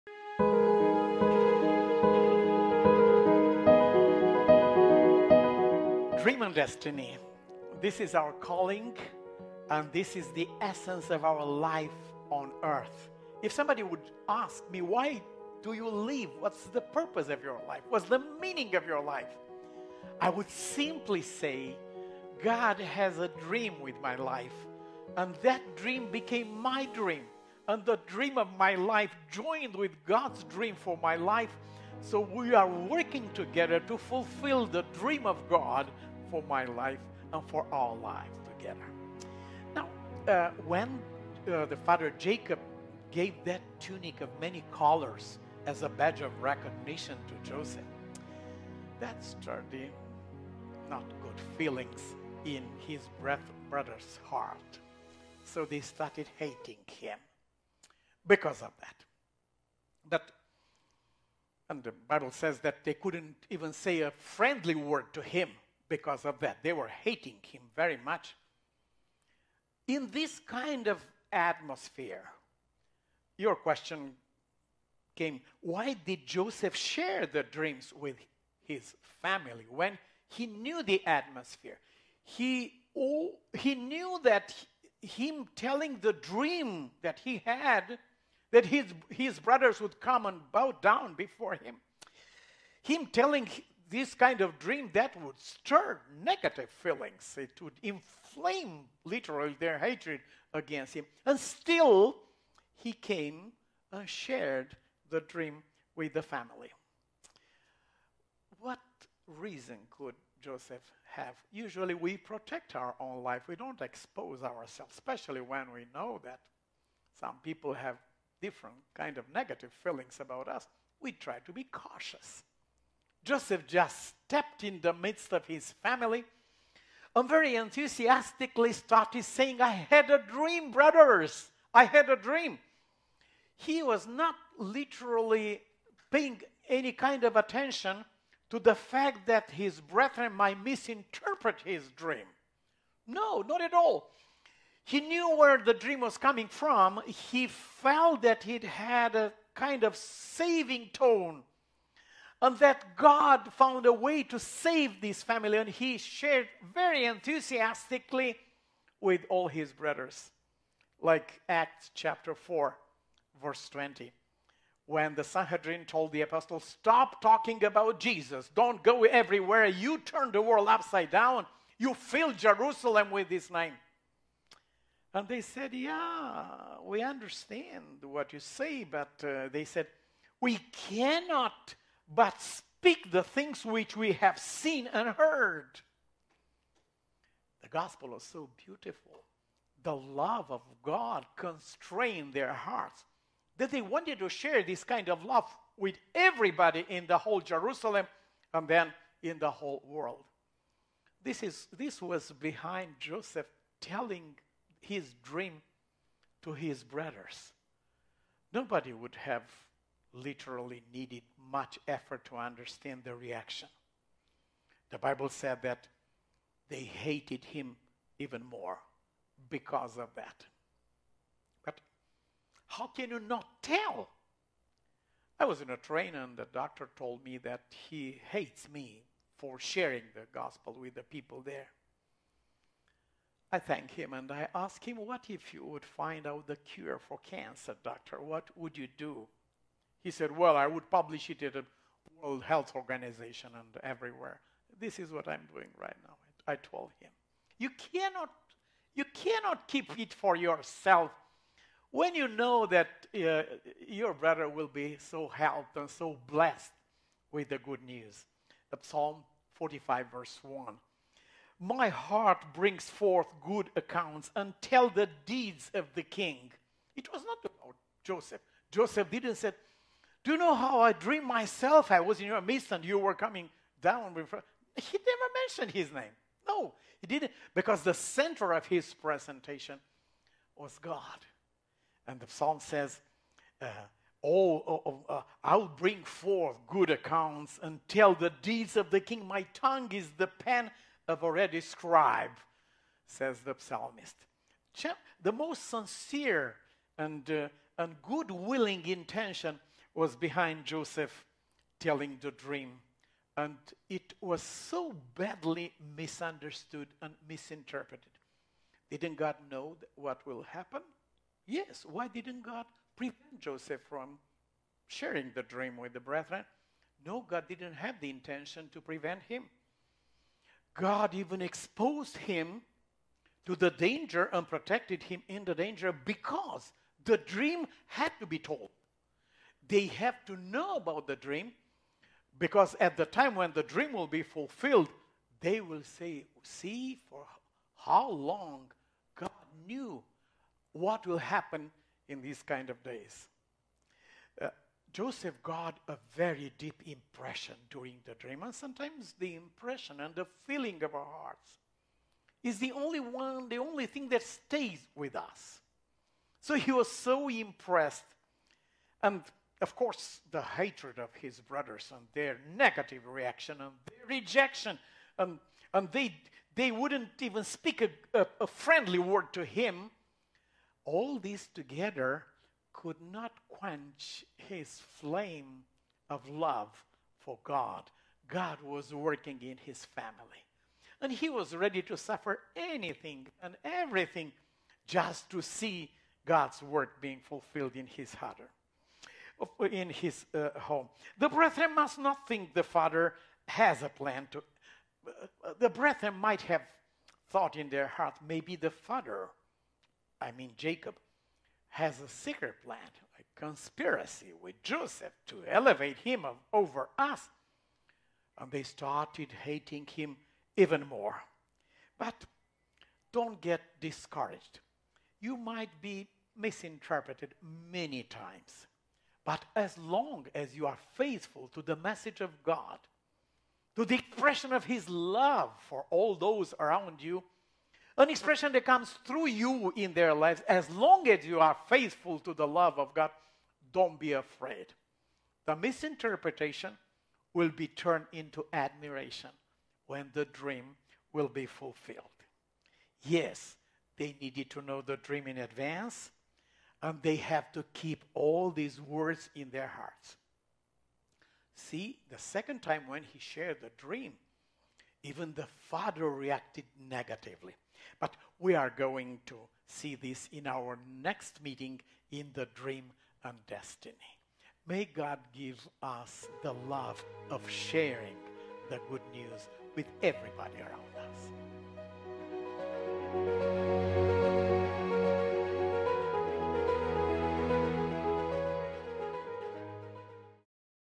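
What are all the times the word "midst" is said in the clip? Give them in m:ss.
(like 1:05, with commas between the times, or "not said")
2:04, 4:32.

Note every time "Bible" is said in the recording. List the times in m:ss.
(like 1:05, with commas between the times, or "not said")
1:02, 3:34.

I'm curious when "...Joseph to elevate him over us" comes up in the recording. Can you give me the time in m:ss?
6:44.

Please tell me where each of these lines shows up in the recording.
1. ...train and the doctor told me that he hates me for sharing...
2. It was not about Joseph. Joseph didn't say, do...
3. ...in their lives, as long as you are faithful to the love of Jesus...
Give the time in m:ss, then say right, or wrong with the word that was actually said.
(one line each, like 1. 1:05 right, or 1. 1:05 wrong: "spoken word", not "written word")
1. 3:45 right
2. 4:26 right
3. 7:09 wrong: "God", not "Jesus".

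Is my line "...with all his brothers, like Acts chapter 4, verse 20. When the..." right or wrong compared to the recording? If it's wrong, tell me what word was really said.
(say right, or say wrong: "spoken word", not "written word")
right.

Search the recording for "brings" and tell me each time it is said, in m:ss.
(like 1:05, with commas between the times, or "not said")
4:22, 4:45.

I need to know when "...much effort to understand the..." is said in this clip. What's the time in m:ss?
3:31.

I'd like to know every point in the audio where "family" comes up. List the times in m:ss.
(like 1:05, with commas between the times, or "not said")
1:19, 1:46, 2:05, 2:35, 6:19.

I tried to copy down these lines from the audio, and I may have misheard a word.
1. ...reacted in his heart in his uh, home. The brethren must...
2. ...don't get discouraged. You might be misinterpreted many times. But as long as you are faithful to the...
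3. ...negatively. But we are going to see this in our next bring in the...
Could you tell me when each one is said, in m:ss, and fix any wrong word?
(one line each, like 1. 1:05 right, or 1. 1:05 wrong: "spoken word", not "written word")
1. 6:27 wrong: "fulfilled", not "reacted"
2. 6:53 right
3. 7:36 wrong: "meeting", not "bring".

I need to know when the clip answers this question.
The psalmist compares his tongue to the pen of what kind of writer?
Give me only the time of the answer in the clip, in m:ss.
4:51.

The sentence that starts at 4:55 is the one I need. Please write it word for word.
The most sincere and, uh, and good willing intention was behind Joseph telling the dream.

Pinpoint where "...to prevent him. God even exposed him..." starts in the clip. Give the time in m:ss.
5:18.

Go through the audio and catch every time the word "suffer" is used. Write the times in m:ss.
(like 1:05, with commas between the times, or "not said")
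6:21.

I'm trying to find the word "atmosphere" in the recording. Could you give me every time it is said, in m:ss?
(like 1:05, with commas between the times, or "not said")
1:11, 1:21.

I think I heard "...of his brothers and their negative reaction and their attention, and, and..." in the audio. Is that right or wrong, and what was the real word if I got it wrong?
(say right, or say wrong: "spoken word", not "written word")
wrong: "rejection", not "attention".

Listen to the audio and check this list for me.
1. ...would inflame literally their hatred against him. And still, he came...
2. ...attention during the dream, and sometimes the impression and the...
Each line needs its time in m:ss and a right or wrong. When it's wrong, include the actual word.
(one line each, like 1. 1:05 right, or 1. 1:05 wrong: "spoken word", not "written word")
1. 1:37 right
2. 5:46 wrong: "impression", not "attention".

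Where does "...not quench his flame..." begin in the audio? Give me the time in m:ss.
6:13.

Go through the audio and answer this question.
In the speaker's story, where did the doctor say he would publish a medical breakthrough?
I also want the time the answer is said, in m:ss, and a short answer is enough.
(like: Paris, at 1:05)
World Health Organization, at 4:02.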